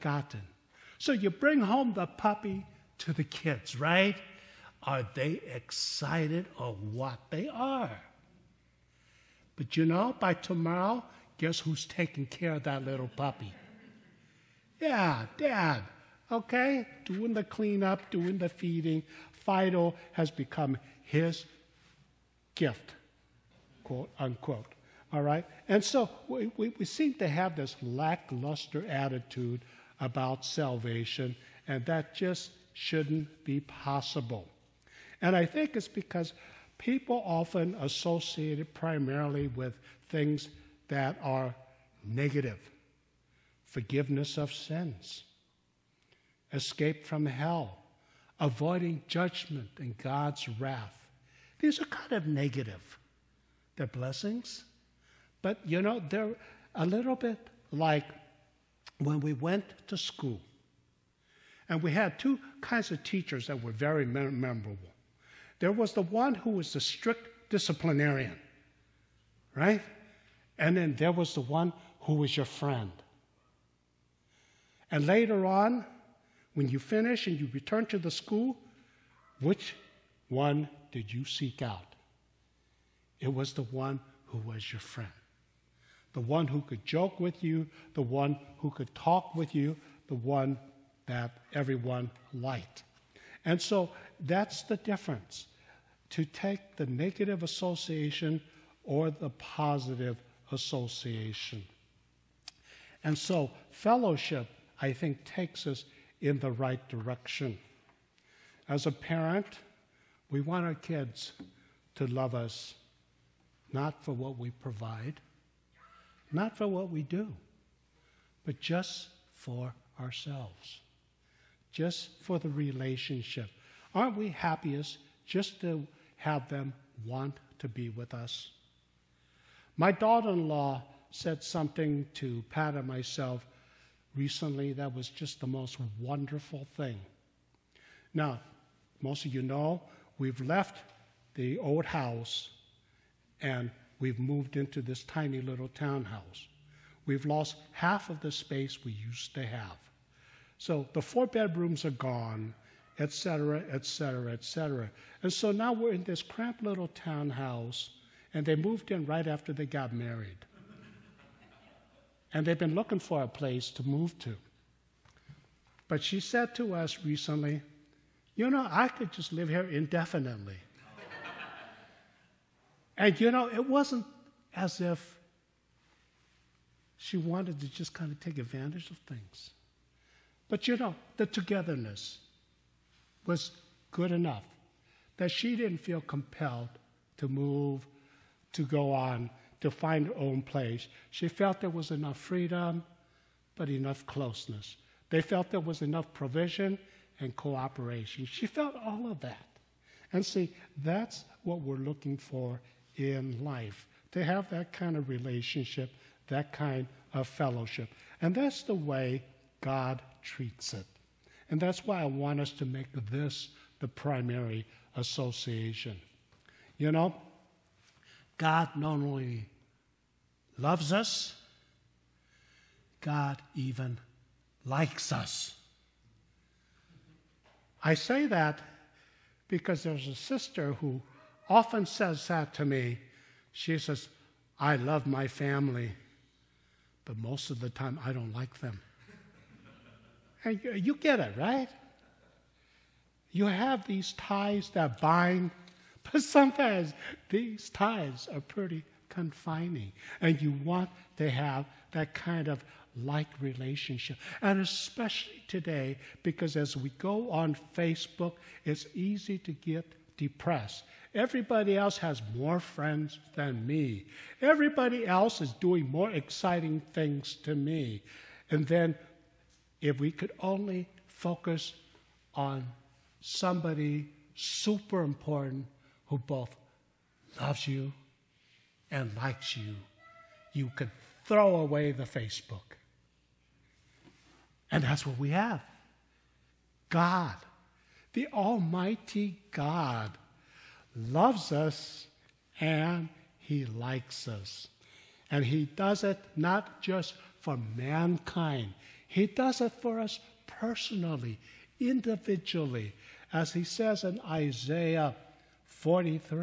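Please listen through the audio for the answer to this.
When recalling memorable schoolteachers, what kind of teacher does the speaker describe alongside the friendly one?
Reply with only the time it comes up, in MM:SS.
01:06.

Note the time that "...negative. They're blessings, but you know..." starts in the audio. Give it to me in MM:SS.
00:52.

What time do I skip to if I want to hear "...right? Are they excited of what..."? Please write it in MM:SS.
00:03.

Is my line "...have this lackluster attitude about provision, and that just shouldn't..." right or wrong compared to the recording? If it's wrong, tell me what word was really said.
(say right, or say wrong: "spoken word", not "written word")
wrong: "salvation", not "provision".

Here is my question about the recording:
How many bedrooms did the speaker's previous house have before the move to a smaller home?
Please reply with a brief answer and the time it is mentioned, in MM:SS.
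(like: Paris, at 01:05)
4, at 02:31.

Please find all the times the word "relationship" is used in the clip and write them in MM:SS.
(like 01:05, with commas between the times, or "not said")
02:02, 03:25, 04:13.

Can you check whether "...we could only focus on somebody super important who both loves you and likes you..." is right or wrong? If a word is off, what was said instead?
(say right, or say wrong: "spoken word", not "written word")
right.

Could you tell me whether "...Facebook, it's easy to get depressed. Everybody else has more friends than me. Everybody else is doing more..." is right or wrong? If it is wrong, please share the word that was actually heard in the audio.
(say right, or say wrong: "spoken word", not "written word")
right.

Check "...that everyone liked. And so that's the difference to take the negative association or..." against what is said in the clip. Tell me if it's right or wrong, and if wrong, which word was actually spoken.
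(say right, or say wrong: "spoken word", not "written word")
right.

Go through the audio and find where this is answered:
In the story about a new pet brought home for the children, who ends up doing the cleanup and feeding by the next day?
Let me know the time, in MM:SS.
00:15.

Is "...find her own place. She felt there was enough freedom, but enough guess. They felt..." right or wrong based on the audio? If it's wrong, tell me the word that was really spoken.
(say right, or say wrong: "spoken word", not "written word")
wrong: "closeness", not "guess".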